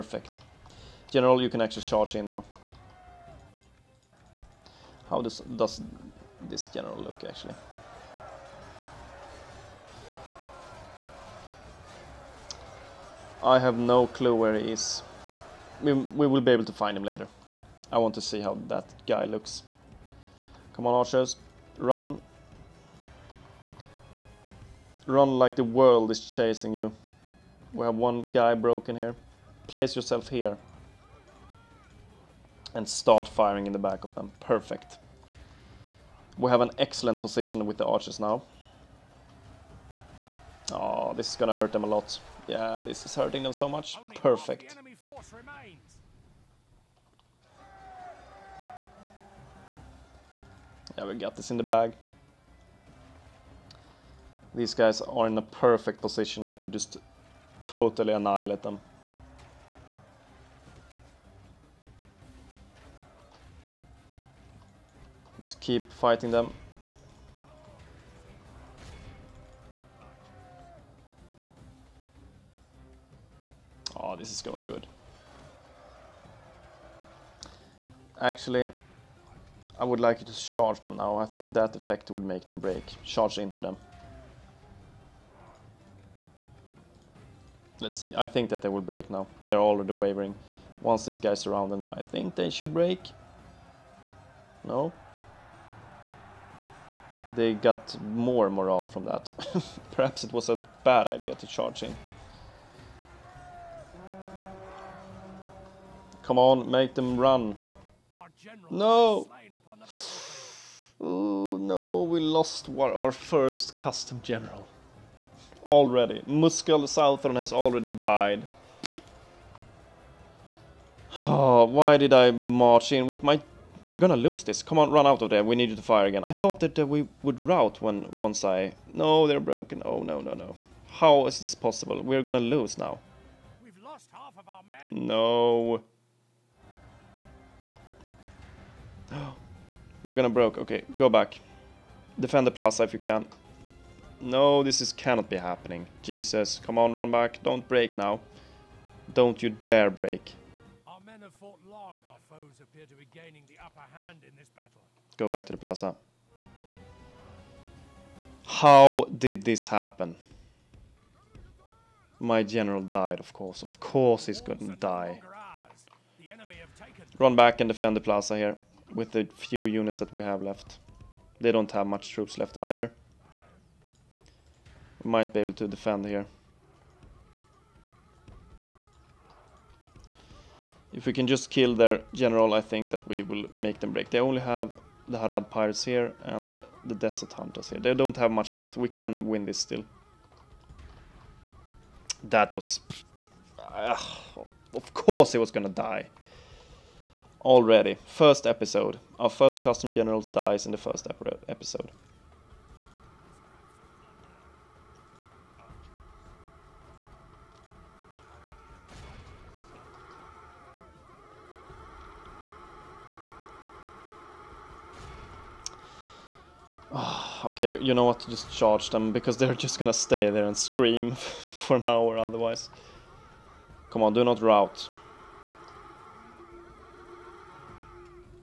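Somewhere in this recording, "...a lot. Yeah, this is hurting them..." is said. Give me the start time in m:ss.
0:41.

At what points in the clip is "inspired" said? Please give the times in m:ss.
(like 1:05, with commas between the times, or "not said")
not said.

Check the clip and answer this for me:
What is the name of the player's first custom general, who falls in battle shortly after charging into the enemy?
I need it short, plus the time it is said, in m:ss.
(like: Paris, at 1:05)
Muskel Southron, at 1:56.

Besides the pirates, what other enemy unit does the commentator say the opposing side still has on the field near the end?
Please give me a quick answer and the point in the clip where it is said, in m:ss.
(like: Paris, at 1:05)
Desert Hunters, at 3:06.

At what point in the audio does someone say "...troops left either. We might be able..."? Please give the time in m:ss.
2:52.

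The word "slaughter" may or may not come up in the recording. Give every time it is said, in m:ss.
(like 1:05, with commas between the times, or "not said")
not said.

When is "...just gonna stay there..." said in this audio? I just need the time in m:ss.
3:39.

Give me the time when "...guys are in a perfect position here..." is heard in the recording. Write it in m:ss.
0:54.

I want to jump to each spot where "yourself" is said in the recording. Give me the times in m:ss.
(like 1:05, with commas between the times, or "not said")
0:29.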